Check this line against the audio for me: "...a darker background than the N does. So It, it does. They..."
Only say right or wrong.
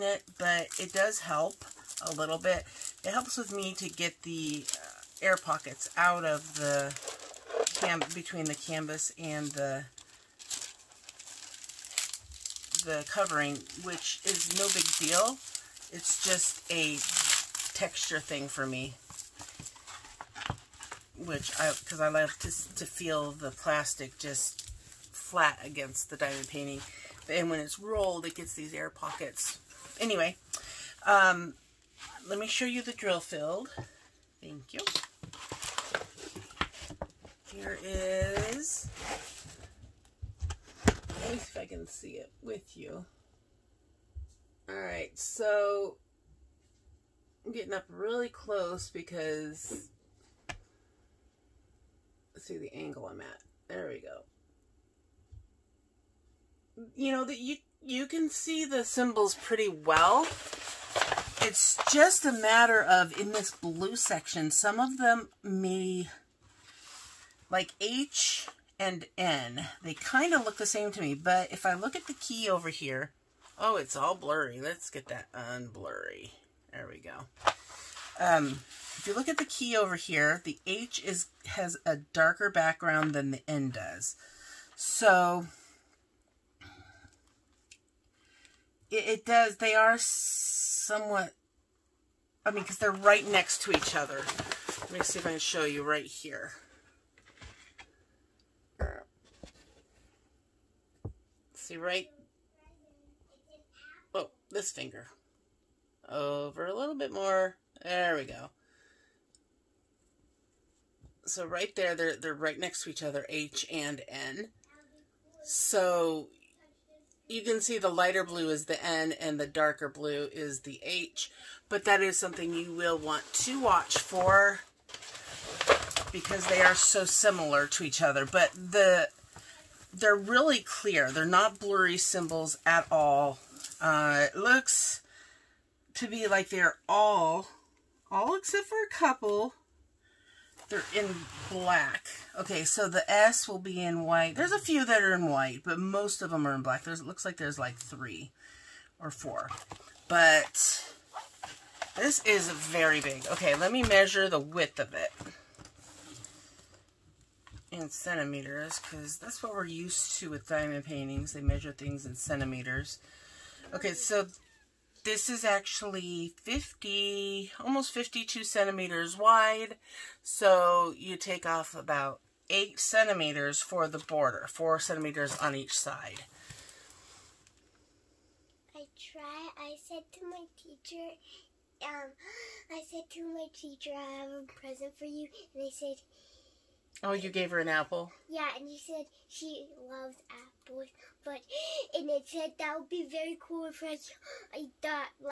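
right.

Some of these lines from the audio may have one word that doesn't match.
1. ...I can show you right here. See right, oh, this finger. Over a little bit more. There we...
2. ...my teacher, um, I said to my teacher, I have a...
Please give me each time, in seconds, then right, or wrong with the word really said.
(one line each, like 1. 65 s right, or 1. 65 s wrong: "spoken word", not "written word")
1. 95 s right
2. 180 s right.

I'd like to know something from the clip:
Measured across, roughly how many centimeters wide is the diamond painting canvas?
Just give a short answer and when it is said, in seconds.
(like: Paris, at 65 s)
almost 52 centimeters, at 167 s.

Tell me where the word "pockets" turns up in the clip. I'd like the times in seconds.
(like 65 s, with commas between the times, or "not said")
5 s, 28 s.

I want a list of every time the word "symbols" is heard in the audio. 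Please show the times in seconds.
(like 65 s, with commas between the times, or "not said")
58 s, 131 s.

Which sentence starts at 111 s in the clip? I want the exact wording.
So right there, they're, they're right next to each other, H and N.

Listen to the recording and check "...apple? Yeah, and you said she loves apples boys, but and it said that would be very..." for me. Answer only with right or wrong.
right.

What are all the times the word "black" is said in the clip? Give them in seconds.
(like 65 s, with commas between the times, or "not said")
141 s, 146 s.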